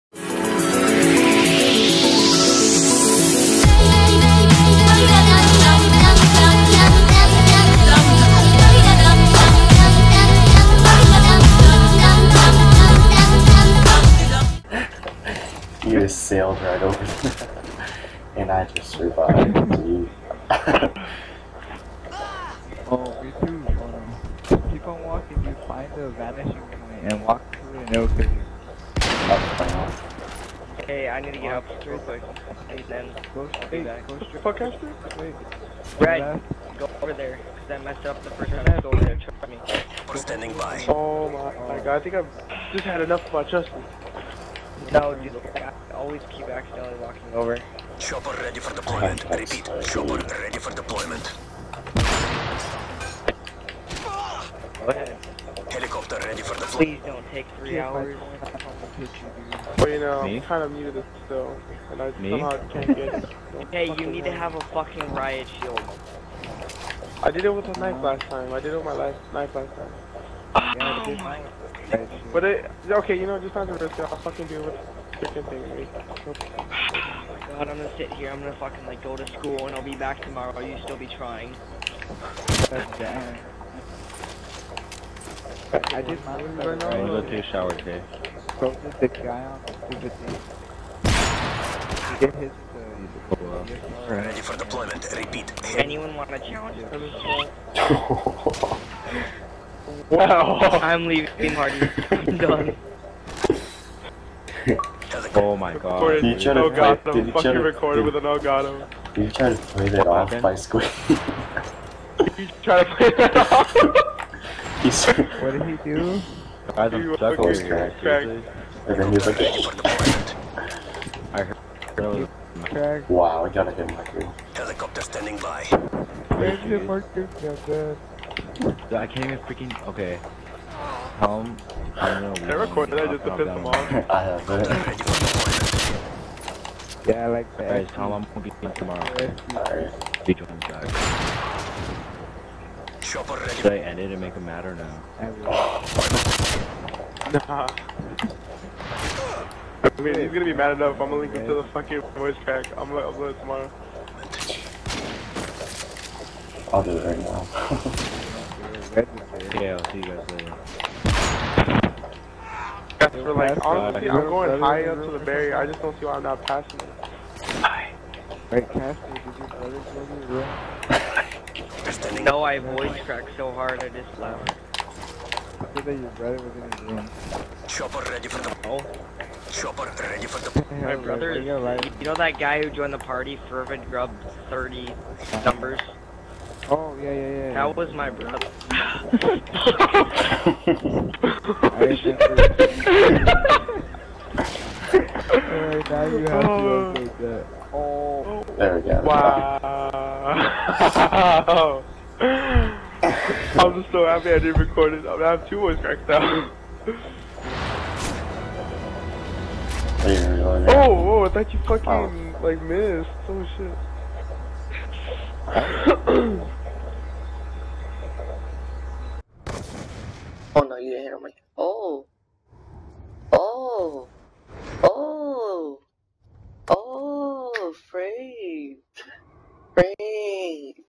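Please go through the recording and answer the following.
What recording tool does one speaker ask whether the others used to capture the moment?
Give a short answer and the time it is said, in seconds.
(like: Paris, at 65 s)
Elgato, at 108 s.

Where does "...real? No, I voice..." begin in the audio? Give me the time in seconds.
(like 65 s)
172 s.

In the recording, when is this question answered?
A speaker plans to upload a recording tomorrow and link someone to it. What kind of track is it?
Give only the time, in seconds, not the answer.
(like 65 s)
152 s.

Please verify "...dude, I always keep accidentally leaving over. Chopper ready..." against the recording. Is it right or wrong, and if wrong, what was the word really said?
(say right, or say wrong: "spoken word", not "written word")
wrong: "walking", not "leaving".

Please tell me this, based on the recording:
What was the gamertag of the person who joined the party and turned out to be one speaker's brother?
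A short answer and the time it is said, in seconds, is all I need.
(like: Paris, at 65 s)
Fervent Grub 30, at 183 s.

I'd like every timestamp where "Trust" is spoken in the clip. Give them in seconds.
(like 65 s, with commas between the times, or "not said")
39 s.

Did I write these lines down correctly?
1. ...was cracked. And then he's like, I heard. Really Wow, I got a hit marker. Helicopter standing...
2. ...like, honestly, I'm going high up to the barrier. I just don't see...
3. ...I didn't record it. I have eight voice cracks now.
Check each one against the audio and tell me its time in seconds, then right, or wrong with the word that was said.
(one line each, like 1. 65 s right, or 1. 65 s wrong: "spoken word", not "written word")
1. 117 s right
2. 163 s right
3. 204 s wrong: "two", not "eight".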